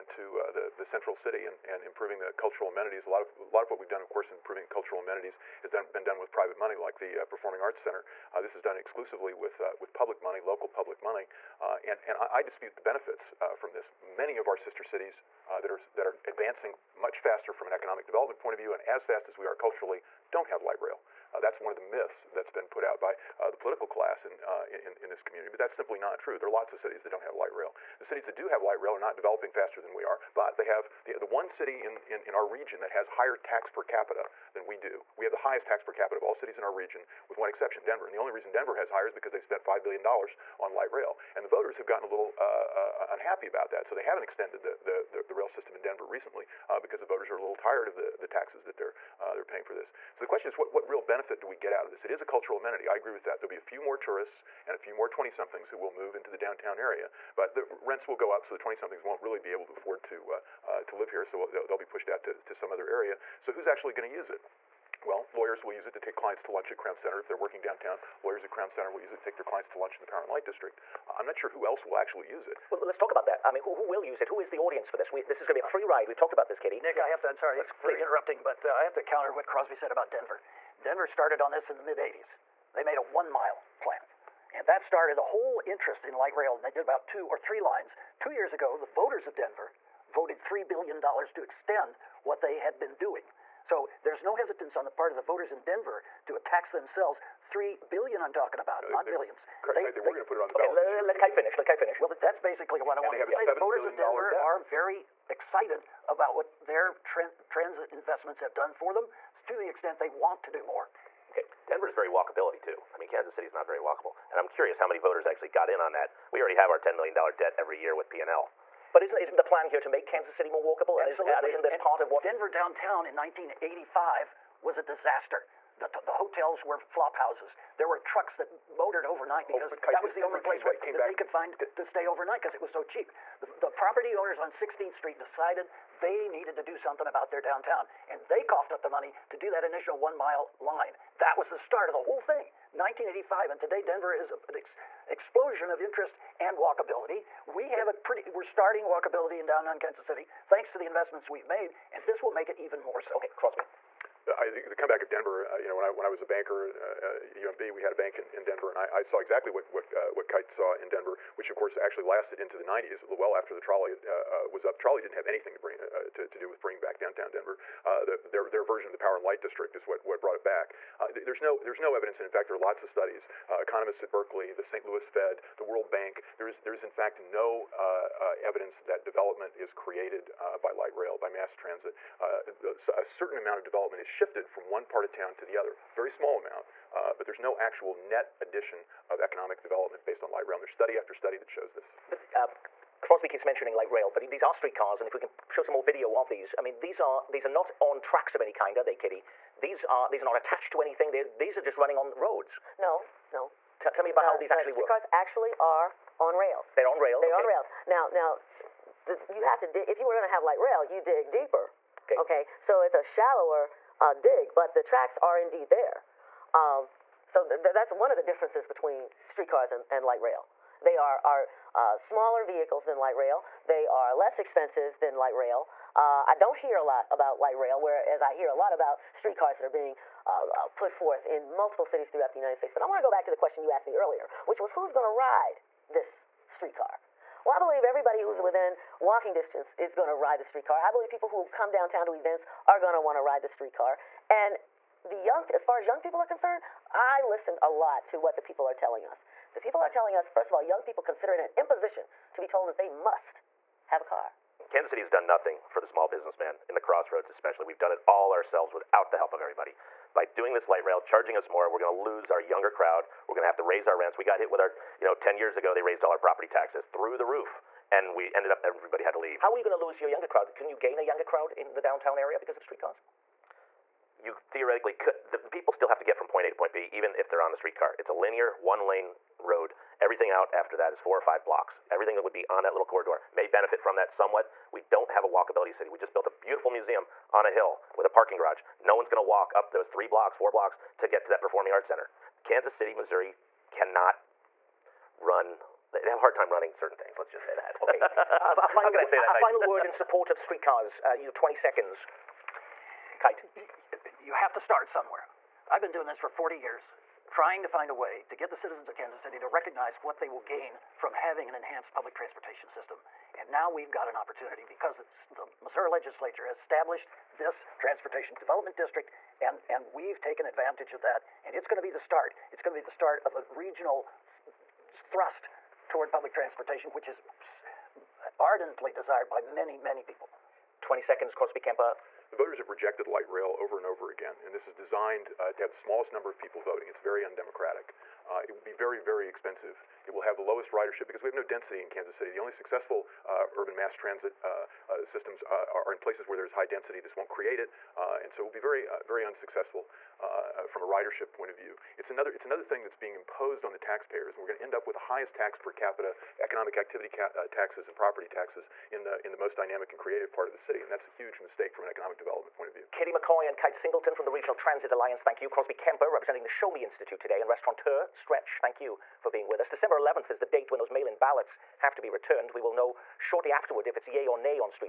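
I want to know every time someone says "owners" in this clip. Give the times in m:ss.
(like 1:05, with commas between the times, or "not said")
2:14.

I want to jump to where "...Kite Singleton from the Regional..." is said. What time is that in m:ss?
6:03.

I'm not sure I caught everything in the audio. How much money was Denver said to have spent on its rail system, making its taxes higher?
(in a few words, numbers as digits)
$5 billion.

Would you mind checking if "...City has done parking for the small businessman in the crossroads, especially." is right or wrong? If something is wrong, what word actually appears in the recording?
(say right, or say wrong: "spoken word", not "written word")
wrong: "nothing", not "parking".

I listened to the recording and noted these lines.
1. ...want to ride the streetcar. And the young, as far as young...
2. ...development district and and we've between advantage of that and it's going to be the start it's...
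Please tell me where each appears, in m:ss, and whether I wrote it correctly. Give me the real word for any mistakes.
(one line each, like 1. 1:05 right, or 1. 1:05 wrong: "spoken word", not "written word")
1. 4:02 right
2. 5:18 wrong: "taken", not "between".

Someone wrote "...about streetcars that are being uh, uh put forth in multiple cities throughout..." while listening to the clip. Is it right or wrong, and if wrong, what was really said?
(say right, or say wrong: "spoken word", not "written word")
right.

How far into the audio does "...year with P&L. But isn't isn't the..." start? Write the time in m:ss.
1:57.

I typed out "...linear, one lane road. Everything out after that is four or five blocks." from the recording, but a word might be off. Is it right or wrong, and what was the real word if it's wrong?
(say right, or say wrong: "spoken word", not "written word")
right.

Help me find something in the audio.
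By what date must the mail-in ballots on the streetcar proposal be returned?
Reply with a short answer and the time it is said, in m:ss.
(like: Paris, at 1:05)
December 11, at 6:09.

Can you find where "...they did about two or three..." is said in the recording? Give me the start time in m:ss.
1:26.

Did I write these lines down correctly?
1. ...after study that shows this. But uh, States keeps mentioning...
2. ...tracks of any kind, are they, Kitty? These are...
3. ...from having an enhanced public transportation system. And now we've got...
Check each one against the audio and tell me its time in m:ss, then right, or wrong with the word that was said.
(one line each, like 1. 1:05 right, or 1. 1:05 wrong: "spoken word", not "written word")
1. 3:10 wrong: "Crosby", not "States"
2. 3:18 right
3. 5:10 right.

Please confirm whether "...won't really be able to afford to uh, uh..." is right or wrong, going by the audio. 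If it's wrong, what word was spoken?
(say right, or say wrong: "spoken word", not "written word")
right.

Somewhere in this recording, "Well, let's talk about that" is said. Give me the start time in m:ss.
1:12.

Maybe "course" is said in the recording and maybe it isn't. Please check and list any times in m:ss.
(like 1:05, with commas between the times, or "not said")
0:04, 2:41.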